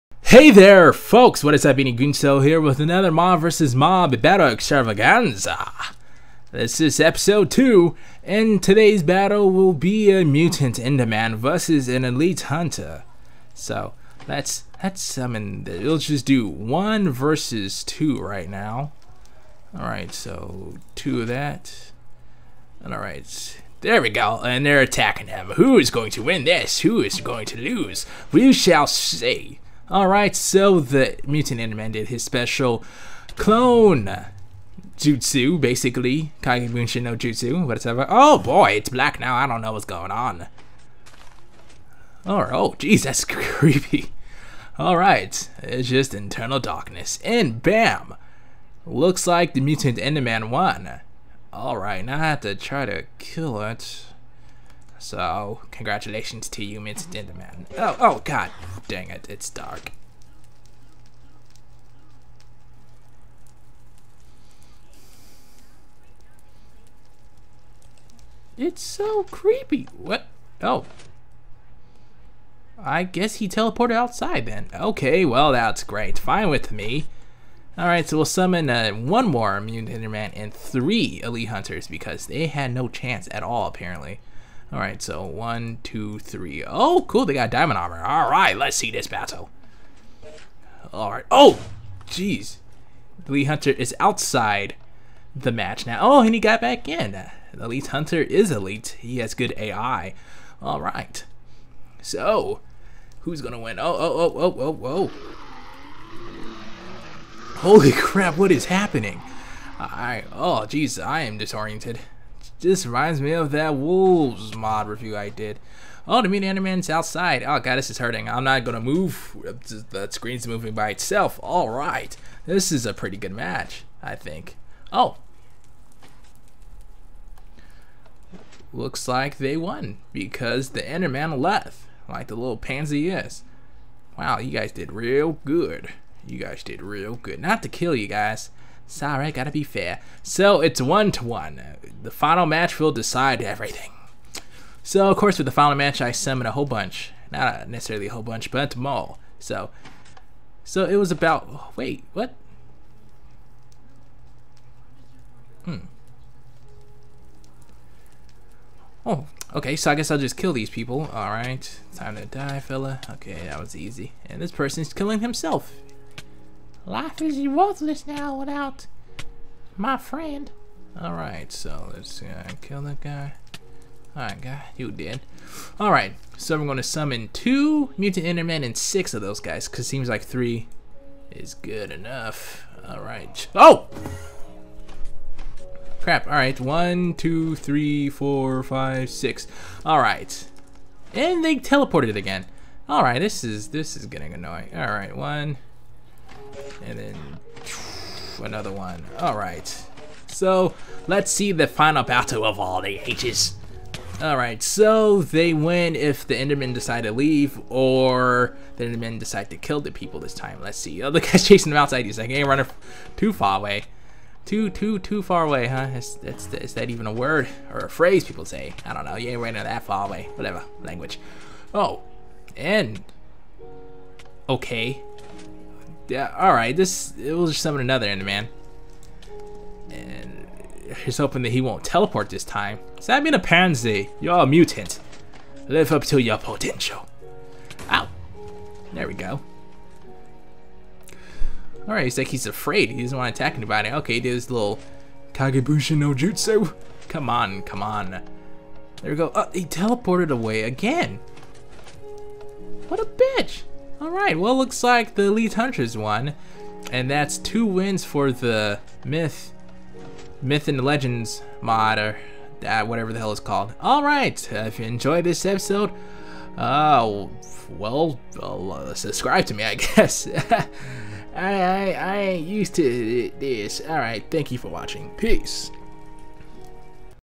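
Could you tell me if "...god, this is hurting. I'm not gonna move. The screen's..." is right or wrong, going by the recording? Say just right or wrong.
right.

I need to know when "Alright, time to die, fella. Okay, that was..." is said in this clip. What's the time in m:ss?
2:41.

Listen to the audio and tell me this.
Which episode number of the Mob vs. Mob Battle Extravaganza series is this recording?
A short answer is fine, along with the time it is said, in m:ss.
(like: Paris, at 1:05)
2, at 0:07.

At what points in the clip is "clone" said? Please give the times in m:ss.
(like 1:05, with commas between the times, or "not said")
0:33.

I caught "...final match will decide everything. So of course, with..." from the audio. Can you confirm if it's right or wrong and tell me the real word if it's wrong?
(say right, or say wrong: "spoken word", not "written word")
right.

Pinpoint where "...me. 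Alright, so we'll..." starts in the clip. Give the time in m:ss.
1:16.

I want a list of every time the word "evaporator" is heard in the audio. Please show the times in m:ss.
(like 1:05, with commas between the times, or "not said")
not said.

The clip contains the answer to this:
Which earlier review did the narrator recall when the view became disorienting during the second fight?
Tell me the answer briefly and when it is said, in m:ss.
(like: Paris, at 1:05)
Wolves mod review, at 1:53.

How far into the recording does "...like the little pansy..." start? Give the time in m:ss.
2:12.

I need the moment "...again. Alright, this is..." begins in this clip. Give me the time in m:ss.
3:12.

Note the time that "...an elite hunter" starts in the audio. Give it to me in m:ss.
0:11.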